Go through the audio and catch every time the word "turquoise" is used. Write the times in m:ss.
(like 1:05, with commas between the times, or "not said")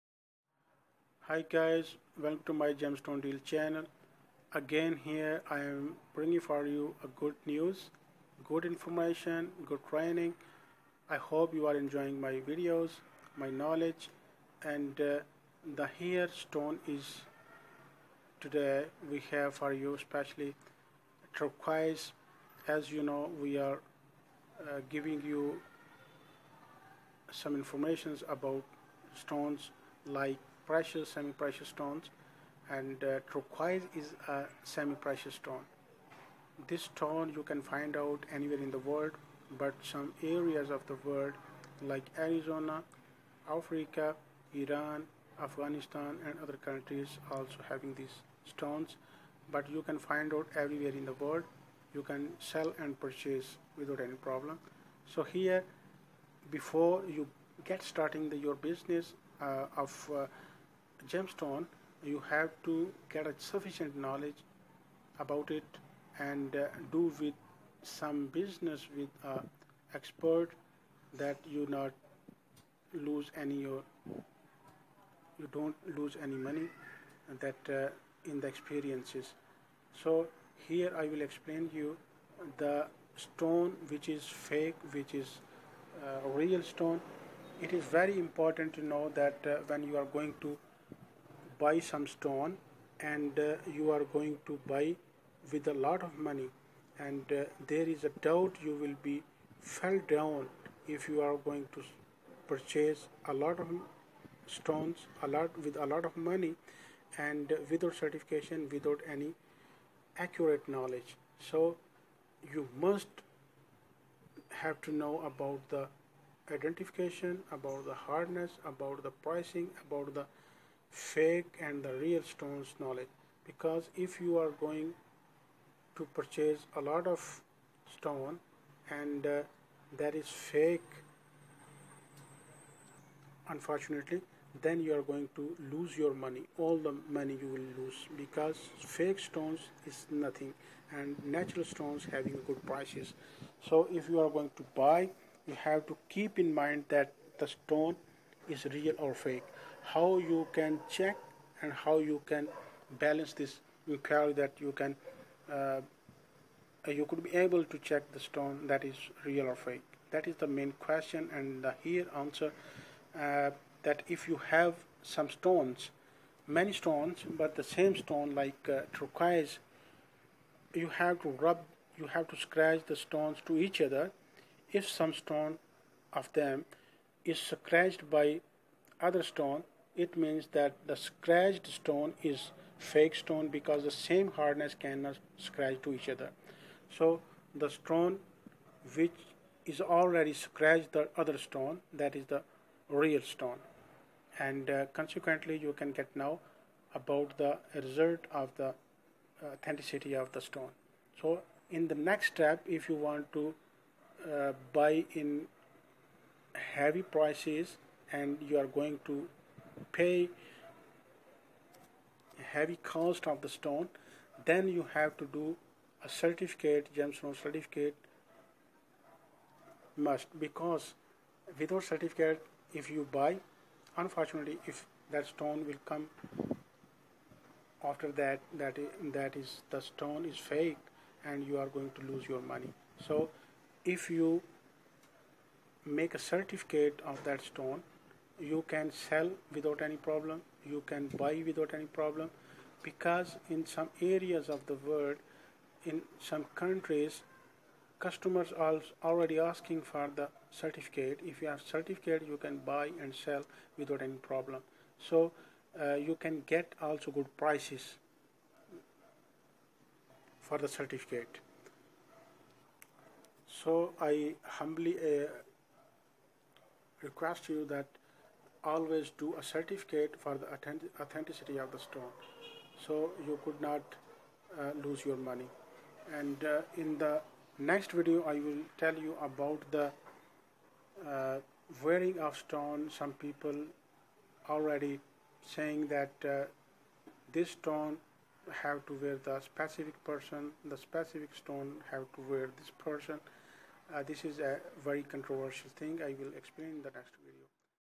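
0:21, 0:33, 2:48.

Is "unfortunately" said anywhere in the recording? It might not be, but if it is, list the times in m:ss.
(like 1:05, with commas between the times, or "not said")
2:13, 3:43.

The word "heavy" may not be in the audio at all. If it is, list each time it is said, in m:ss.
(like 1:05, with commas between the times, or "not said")
3:26, 3:32.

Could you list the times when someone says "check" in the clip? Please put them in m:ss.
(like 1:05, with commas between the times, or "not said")
2:30, 2:37.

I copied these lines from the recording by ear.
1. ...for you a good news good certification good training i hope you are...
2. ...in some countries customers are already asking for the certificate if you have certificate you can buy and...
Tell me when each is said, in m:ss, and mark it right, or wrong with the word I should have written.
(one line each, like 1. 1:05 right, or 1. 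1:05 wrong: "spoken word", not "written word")
1. 0:06 wrong: "information", not "certification"
2. 4:05 right.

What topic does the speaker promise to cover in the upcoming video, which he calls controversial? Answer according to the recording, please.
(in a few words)
wearing of stone.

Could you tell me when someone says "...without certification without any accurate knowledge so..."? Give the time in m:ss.
1:47.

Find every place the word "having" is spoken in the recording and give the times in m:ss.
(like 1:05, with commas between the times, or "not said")
0:47, 2:22.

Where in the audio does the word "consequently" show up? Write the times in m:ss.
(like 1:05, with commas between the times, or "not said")
3:14.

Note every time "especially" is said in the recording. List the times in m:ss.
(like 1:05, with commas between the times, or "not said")
0:19.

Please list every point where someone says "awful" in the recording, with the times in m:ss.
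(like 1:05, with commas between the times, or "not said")
not said.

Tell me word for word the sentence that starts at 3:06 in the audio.
So the stone which is already scratched the other stone, that is the real stone.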